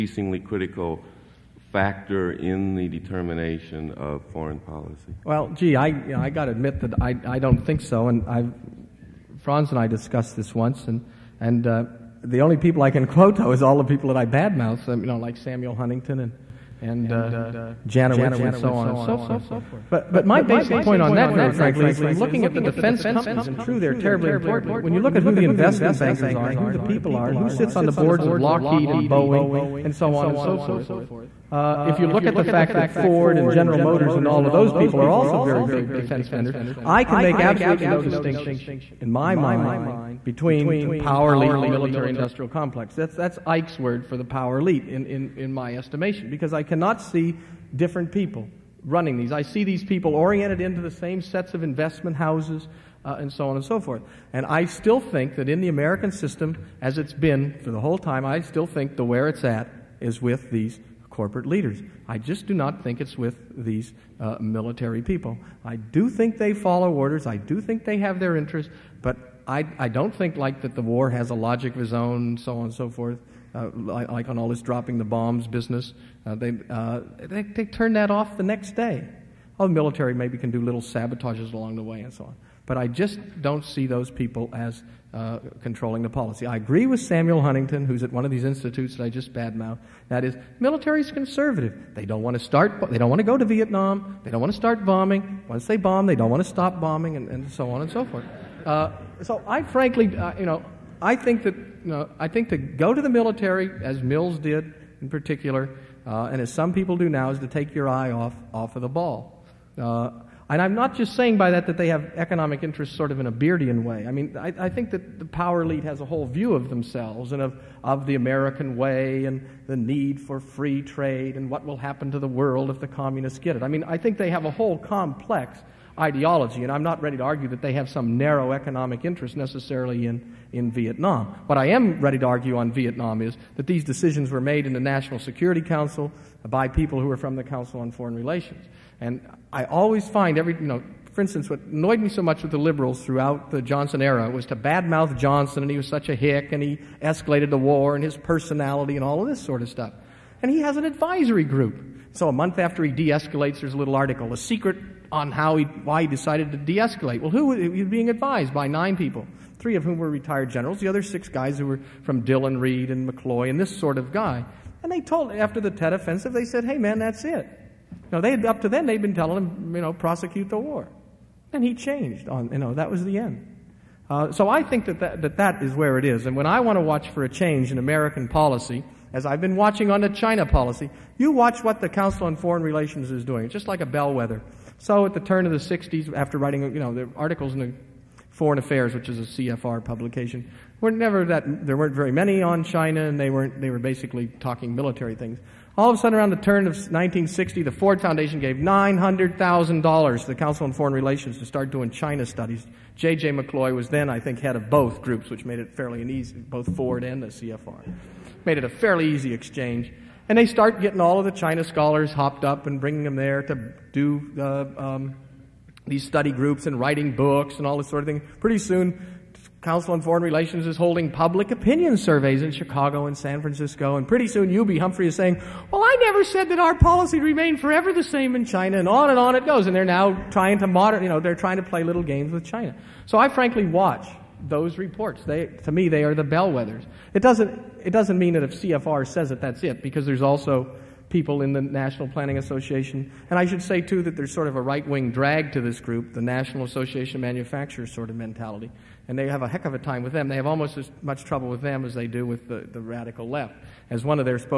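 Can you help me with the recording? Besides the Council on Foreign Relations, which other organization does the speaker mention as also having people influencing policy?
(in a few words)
National Planning Association.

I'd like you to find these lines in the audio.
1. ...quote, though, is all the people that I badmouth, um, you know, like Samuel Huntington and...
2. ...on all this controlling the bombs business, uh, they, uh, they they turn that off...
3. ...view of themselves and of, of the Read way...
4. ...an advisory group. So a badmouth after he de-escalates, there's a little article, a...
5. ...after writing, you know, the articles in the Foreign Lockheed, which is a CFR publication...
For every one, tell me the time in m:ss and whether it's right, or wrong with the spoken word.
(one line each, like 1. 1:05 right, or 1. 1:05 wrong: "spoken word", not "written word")
1. 0:13 right
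2. 1:14 wrong: "dropping", not "controlling"
3. 1:56 wrong: "American", not "Read"
4. 2:30 wrong: "month", not "badmouth"
5. 3:06 wrong: "Affairs", not "Lockheed".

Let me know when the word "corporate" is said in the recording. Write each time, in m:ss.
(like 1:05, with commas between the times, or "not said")
1:01.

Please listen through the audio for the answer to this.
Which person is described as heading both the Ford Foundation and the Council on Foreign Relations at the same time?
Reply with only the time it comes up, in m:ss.
3:22.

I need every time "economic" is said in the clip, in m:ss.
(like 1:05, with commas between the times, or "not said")
1:52, 2:08.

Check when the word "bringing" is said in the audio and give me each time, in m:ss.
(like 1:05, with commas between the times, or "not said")
3:32.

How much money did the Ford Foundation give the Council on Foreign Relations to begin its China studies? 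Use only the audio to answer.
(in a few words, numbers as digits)
$900,000.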